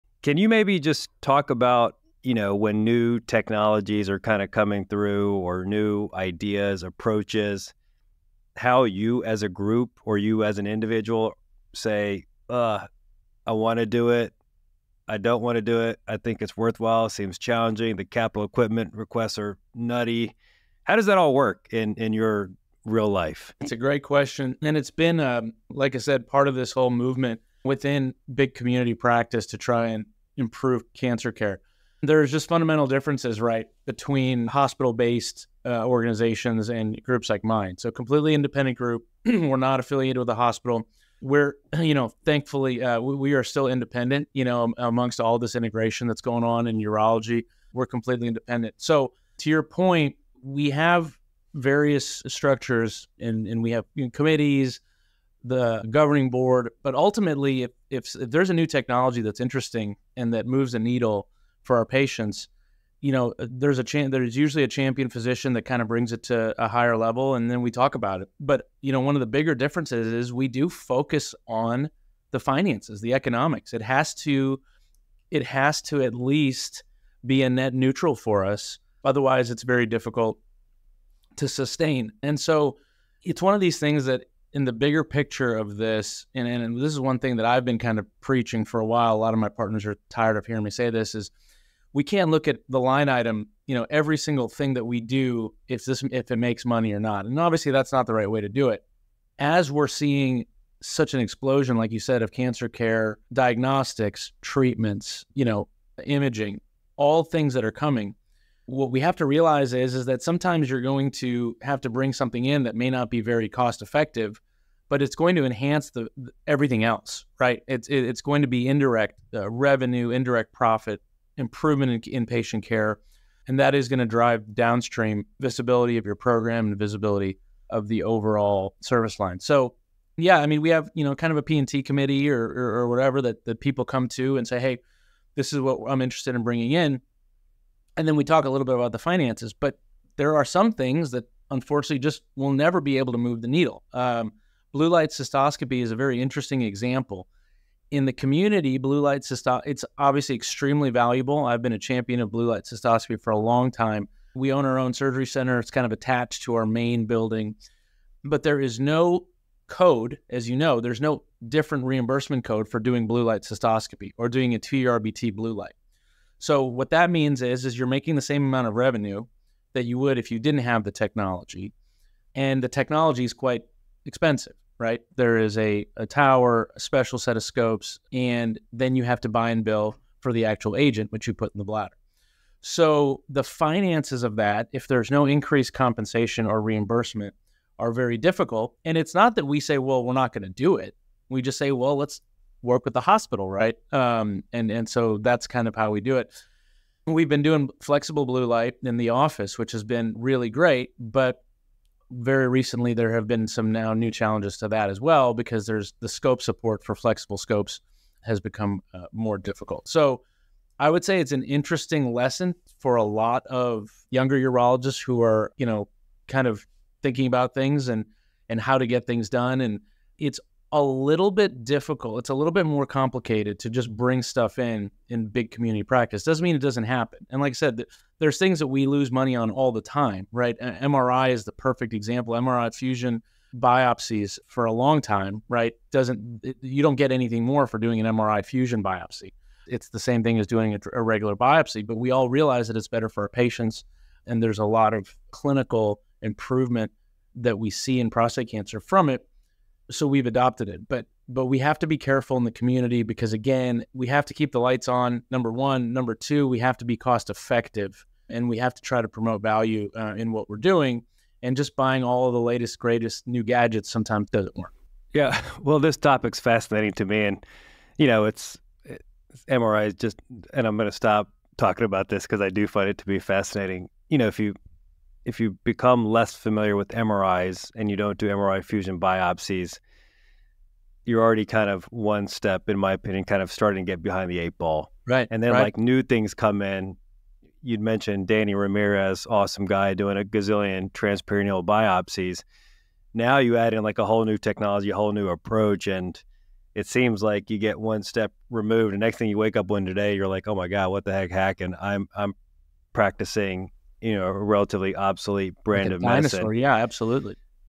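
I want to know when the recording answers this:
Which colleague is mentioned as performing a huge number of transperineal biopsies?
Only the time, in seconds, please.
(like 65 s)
288 s.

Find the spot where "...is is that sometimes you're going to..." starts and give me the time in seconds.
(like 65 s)
109 s.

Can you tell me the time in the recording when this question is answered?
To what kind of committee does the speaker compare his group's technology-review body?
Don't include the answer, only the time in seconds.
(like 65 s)
131 s.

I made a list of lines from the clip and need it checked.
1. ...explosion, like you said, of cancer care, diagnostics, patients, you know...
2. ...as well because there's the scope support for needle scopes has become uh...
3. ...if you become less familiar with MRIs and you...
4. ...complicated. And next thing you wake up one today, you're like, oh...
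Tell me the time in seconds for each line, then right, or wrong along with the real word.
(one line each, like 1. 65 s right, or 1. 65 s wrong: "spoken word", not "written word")
1. 101 s wrong: "treatments", not "patients"
2. 204 s wrong: "flexible", not "needle"
3. 275 s right
4. 298 s wrong: "removed", not "complicated".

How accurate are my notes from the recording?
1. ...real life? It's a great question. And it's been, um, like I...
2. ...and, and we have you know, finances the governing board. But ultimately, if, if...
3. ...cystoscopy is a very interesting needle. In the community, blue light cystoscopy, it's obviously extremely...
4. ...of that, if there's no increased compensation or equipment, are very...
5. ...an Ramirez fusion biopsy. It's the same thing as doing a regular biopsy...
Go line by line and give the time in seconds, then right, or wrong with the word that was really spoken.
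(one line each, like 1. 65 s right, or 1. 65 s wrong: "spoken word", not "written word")
1. 22 s right
2. 53 s wrong: "committees", not "finances"
3. 145 s wrong: "example", not "needle"
4. 184 s wrong: "reimbursement", not "equipment"
5. 237 s wrong: "MRI", not "Ramirez".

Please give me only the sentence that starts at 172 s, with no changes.
And the technology is quite expensive, right?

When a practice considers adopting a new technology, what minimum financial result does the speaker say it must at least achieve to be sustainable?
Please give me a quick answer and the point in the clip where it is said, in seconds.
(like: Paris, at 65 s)
Net neutral, at 77 s.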